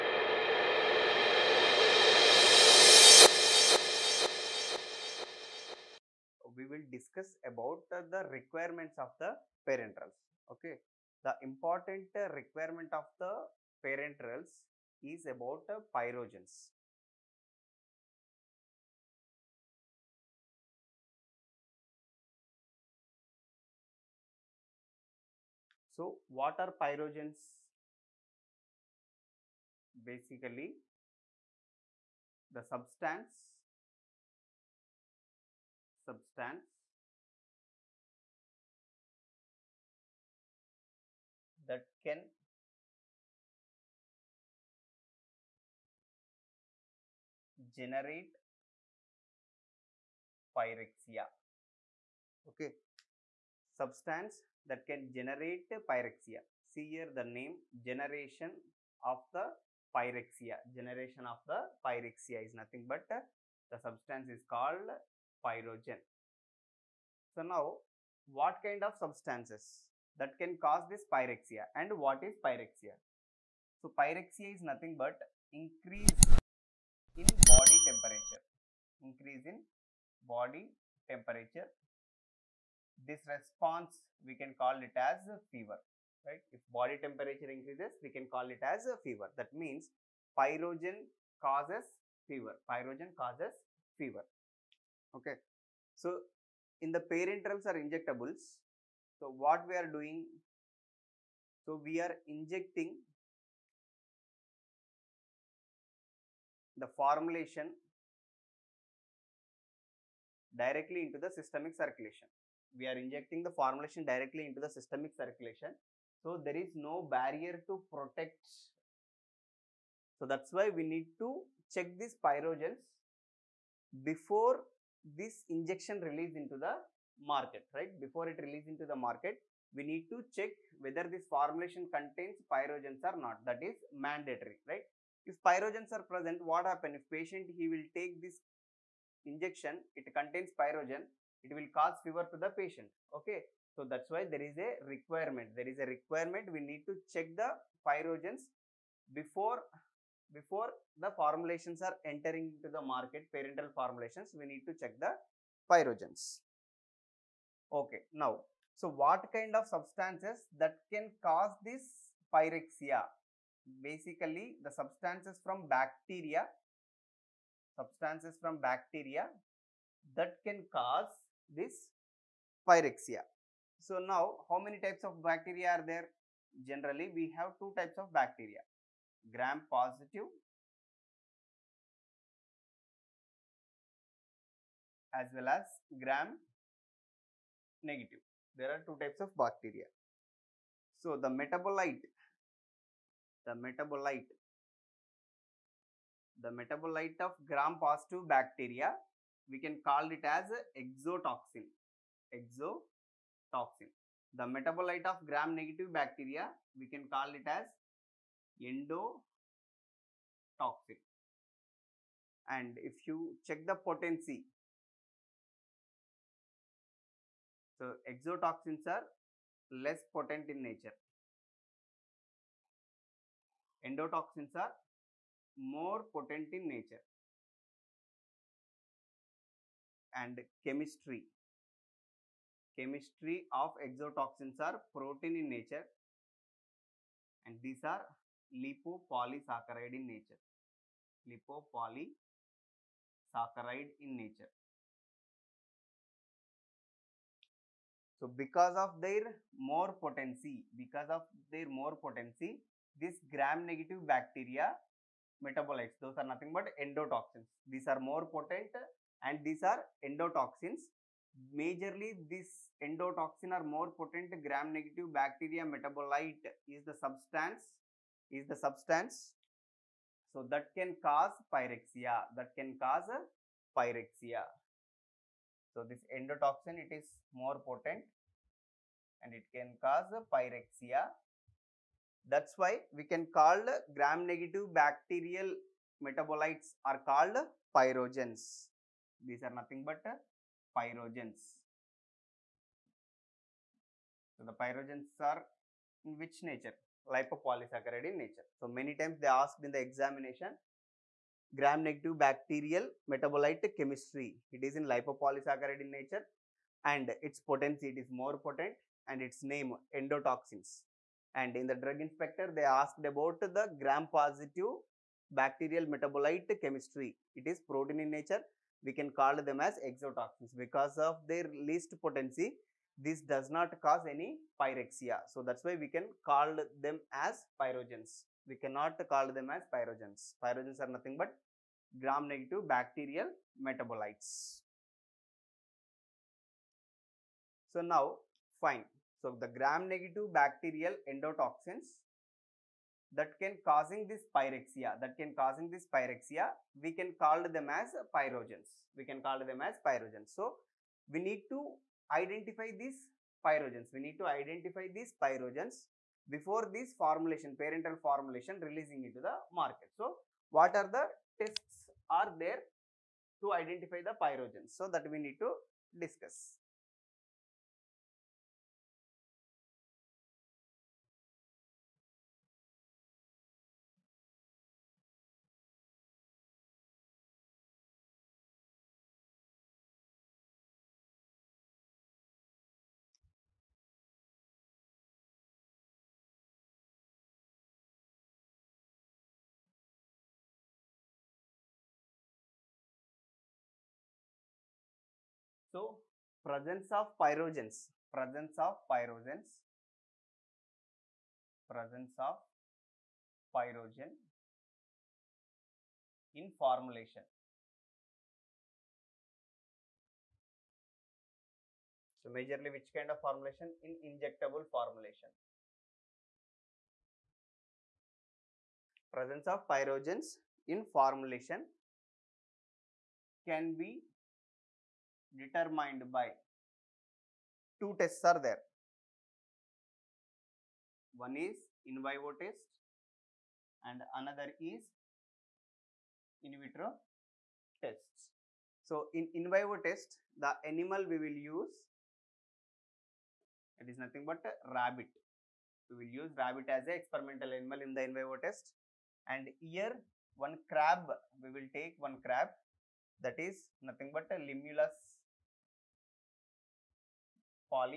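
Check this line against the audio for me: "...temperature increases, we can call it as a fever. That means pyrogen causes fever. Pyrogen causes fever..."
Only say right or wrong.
right.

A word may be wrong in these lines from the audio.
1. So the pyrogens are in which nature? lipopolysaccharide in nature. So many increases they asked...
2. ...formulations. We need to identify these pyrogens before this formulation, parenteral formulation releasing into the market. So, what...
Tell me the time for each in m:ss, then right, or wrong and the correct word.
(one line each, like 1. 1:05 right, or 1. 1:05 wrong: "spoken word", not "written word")
1. 4:54 wrong: "times", not "increases"
2. 5:53 wrong: "pyrogens", not "formulations".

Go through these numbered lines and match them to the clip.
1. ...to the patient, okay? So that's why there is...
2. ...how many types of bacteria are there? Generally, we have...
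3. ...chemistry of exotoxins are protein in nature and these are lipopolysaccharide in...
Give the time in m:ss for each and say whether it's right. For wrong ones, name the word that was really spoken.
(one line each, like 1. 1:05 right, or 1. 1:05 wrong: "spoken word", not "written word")
1. 2:22 right
2. 2:54 right
3. 3:52 right.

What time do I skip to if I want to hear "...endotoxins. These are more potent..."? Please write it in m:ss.
4:16.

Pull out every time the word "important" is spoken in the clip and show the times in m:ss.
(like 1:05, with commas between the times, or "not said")
0:11.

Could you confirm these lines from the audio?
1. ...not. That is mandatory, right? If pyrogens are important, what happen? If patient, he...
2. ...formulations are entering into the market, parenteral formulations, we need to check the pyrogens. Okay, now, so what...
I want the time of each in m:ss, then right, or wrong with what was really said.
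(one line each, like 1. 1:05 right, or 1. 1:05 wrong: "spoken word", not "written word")
1. 2:13 wrong: "present", not "important"
2. 2:31 right.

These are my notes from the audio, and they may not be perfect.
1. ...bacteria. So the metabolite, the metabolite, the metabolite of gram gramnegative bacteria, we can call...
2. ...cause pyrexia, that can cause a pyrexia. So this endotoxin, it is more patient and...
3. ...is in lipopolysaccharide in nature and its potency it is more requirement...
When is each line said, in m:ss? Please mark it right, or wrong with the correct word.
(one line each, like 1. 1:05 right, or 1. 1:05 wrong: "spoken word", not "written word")
1. 3:09 wrong: "positive", not "gramnegative"
2. 4:31 wrong: "potent", not "patient"
3. 5:04 wrong: "potent", not "requirement".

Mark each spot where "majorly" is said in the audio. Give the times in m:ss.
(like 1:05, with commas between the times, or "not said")
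4:21, 6:52.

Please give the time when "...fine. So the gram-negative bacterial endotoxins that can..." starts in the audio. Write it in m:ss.
5:38.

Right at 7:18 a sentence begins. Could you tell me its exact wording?
So, in in vivo test the animal we will use it is nothing but rabbit.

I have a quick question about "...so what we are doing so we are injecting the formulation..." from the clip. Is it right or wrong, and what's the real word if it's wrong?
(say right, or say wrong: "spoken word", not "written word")
right.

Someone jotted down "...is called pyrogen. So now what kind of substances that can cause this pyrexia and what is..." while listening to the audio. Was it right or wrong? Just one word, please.
right.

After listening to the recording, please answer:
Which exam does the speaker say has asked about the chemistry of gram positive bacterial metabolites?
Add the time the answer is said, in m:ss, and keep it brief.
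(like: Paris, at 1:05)
Drug inspector, at 5:11.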